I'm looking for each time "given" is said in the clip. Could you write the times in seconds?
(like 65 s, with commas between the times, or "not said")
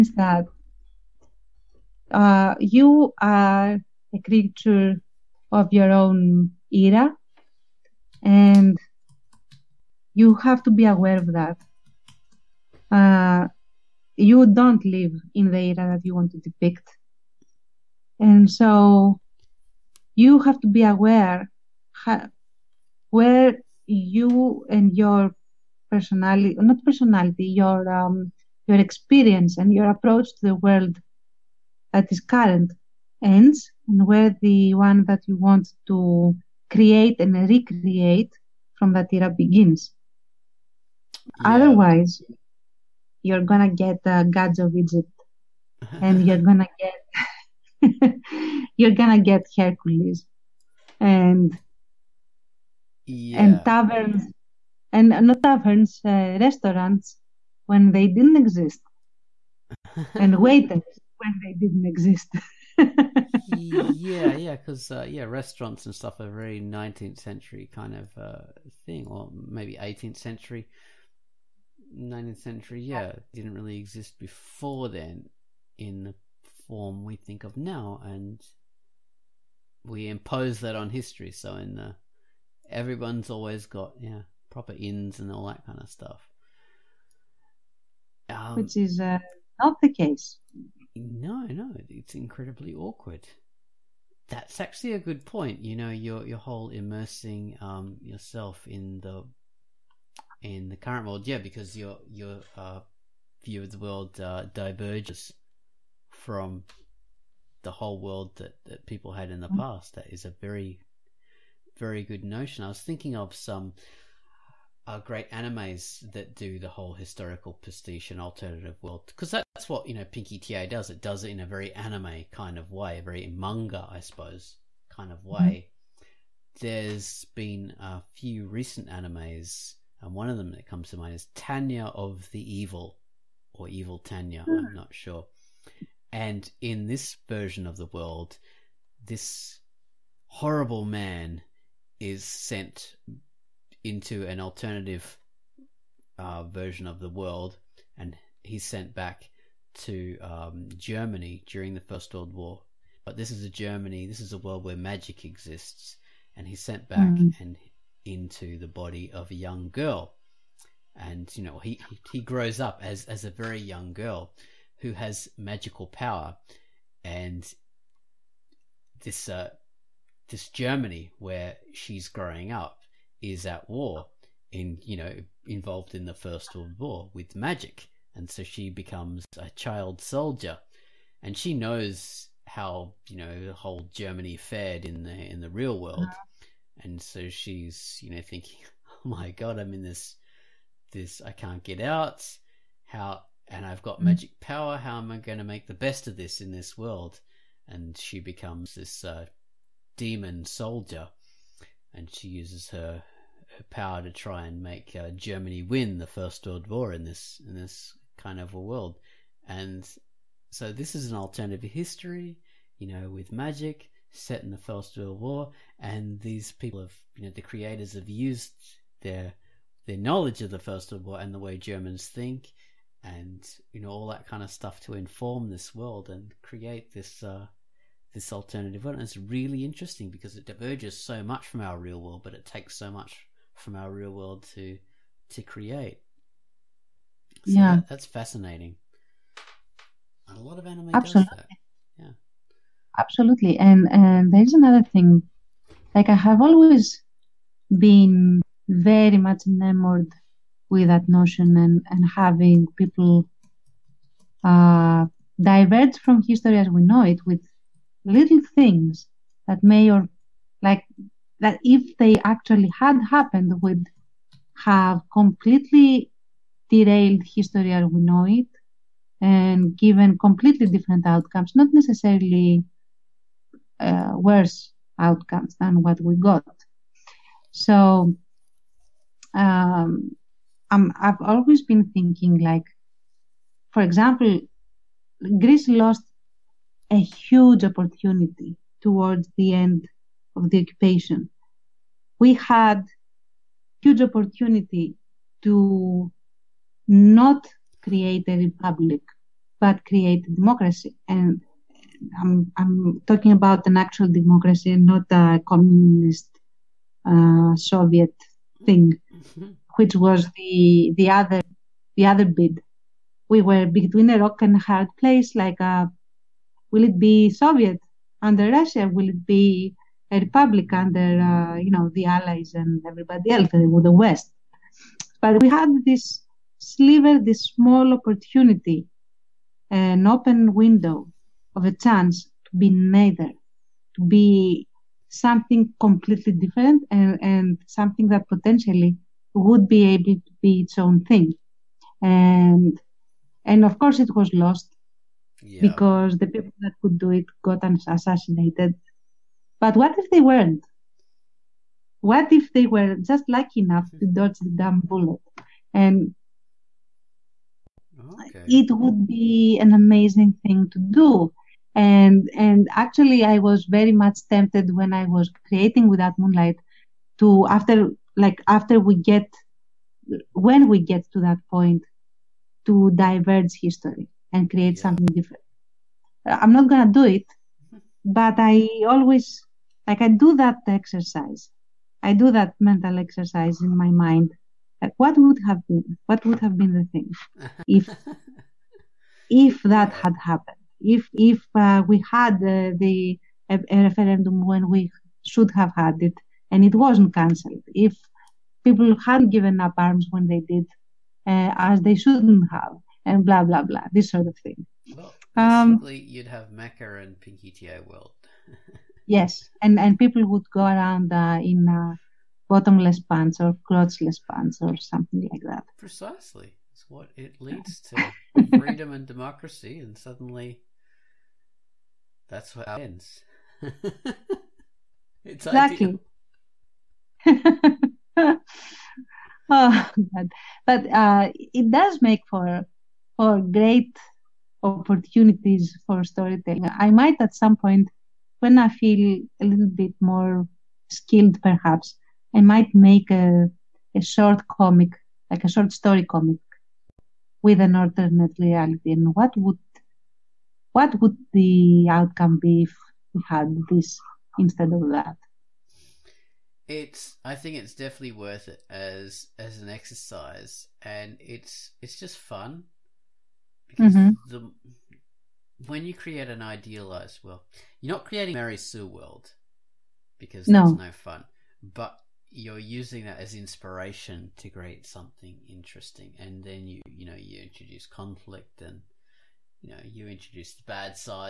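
269 s, 399 s.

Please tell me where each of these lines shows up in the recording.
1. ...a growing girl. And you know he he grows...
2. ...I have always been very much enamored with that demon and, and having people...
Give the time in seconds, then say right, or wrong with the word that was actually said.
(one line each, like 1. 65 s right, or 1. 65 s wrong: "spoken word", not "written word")
1. 159 s wrong: "young", not "growing"
2. 246 s wrong: "notion", not "demon".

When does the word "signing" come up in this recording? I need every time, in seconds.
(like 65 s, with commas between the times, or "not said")
not said.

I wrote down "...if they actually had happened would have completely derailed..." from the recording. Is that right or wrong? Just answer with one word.
right.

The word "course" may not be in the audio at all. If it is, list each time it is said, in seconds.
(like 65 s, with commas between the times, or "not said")
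343 s.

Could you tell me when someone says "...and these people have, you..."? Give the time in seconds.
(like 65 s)
215 s.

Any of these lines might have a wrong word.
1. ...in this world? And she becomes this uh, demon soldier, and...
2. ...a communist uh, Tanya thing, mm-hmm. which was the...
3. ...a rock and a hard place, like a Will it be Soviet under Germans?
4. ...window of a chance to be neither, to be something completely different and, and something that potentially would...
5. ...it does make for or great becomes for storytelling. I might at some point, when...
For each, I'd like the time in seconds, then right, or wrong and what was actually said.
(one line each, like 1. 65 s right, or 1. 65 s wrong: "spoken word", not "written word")
1. 196 s right
2. 305 s wrong: "Soviet", not "Tanya"
3. 314 s wrong: "Russia", not "Germans"
4. 330 s right
5. 431 s wrong: "opportunities", not "becomes".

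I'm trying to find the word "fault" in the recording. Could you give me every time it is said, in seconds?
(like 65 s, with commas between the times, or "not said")
not said.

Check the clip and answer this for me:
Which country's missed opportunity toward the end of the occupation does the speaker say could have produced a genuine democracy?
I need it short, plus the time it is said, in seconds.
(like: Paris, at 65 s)
Greece, at 285 s.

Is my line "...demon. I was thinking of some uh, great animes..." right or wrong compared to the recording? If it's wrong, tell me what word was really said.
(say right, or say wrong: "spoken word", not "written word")
wrong: "notion", not "demon".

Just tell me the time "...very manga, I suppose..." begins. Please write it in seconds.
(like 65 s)
123 s.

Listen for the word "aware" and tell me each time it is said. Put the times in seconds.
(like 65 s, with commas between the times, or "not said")
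10 s, 20 s.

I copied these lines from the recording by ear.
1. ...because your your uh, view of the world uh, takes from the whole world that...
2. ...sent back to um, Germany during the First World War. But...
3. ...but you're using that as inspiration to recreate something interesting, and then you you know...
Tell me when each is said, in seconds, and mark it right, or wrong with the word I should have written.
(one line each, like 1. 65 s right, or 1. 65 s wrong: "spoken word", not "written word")
1. 101 s wrong: "diverges", not "takes"
2. 148 s right
3. 471 s wrong: "create", not "recreate".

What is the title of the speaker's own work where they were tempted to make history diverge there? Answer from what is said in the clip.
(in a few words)
Without Moonlight.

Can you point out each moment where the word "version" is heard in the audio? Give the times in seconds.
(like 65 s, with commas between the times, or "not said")
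137 s, 146 s.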